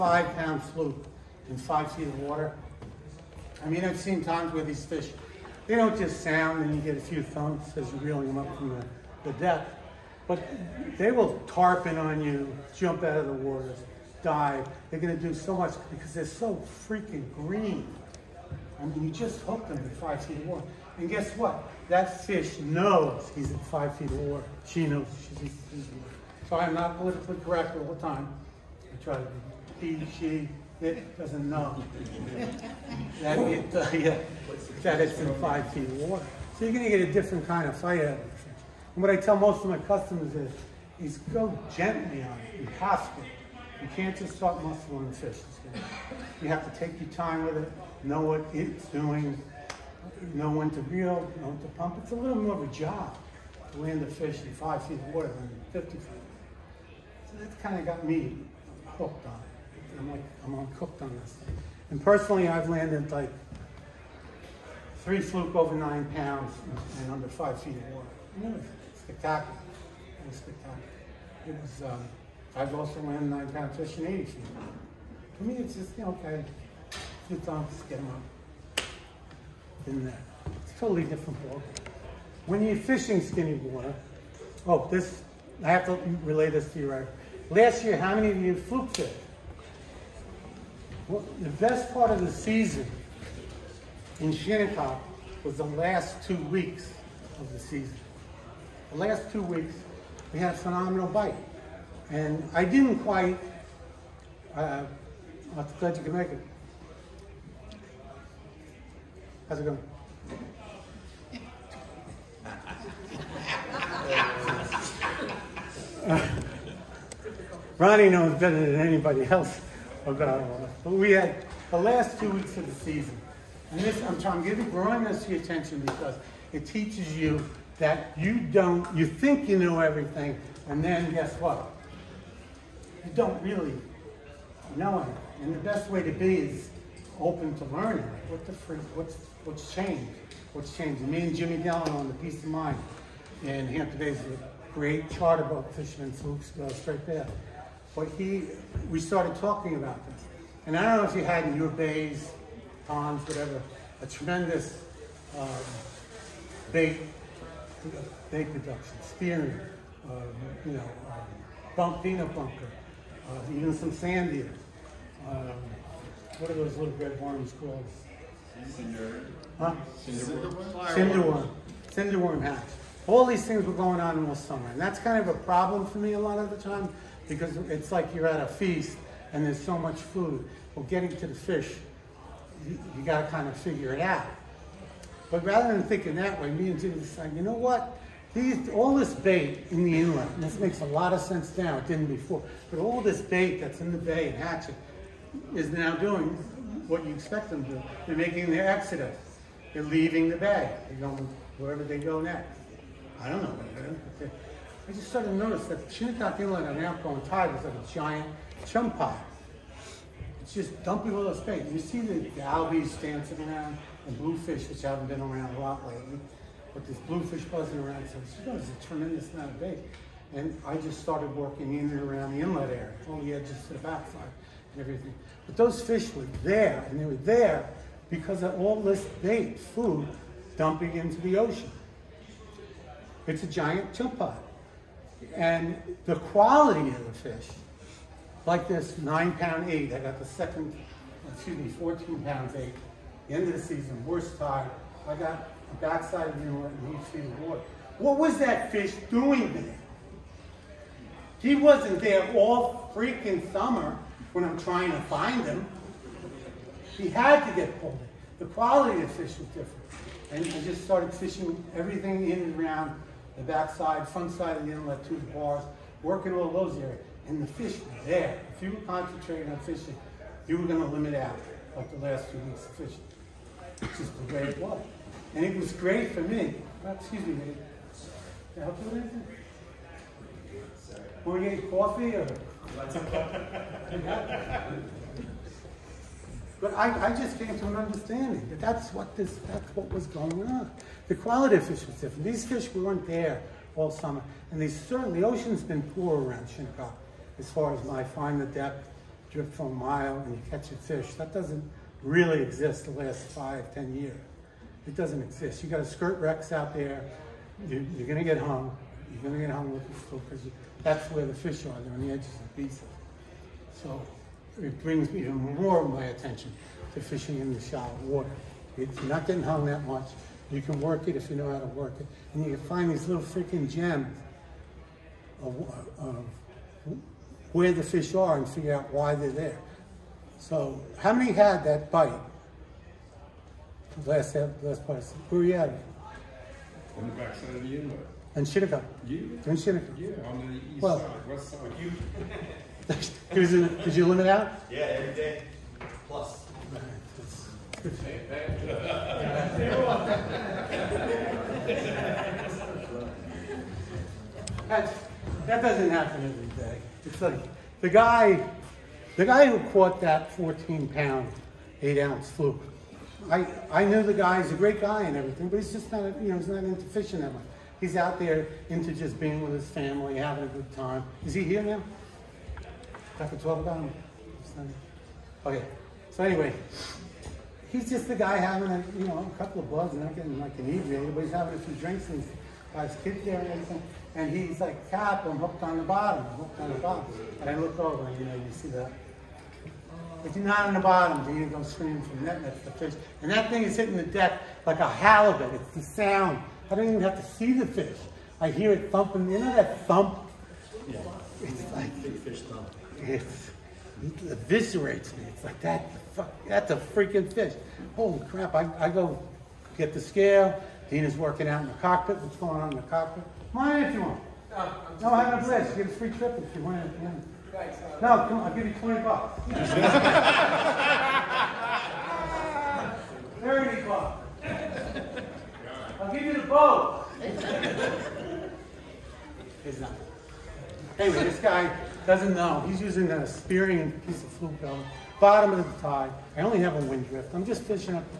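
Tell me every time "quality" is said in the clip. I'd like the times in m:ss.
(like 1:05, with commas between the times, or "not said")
3:56, 4:18, 4:51.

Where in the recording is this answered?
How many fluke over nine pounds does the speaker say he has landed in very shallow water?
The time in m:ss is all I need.
1:05.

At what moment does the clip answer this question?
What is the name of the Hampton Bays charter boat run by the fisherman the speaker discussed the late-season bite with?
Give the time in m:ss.
2:22.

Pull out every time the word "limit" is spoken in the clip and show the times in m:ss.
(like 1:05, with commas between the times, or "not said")
4:30, 5:44.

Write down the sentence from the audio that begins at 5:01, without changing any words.
That doesn't really exist the last five, ten years.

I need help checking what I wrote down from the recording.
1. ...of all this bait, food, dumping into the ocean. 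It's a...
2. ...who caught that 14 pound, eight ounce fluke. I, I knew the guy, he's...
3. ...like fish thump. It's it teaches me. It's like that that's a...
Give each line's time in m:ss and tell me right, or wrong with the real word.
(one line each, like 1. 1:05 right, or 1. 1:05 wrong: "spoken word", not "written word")
1. 3:48 right
2. 5:59 right
3. 6:41 wrong: "eviscerates", not "teaches".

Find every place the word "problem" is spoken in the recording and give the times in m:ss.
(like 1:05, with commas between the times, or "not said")
2:55.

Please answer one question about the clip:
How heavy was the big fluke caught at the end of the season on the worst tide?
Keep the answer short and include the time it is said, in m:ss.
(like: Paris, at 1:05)
14 pounds 8 ounces, at 4:01.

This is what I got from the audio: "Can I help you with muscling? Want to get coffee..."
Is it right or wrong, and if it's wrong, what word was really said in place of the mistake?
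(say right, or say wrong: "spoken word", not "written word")
wrong: "anything", not "muscling".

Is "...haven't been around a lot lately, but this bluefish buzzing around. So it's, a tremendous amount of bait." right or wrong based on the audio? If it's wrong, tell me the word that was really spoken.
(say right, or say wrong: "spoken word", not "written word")
right.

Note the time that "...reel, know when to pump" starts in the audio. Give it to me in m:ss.
0:50.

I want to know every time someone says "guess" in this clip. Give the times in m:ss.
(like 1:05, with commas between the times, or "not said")
0:21, 2:11.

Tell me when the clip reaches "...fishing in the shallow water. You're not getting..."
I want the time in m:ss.
5:17.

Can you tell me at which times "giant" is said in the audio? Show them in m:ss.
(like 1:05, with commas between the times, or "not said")
3:27, 3:53.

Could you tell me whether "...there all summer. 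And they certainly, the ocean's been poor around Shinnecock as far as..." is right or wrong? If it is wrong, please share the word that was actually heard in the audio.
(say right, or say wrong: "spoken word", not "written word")
right.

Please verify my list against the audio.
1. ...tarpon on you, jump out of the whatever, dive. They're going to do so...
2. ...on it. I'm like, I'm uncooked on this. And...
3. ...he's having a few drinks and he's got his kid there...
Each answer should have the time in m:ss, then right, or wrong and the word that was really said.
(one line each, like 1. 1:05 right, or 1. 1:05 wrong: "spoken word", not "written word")
1. 0:11 wrong: "water", not "whatever"
2. 0:59 right
3. 6:21 right.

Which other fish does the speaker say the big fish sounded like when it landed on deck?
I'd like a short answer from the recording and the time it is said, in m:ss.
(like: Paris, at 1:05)
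halibut, at 6:34.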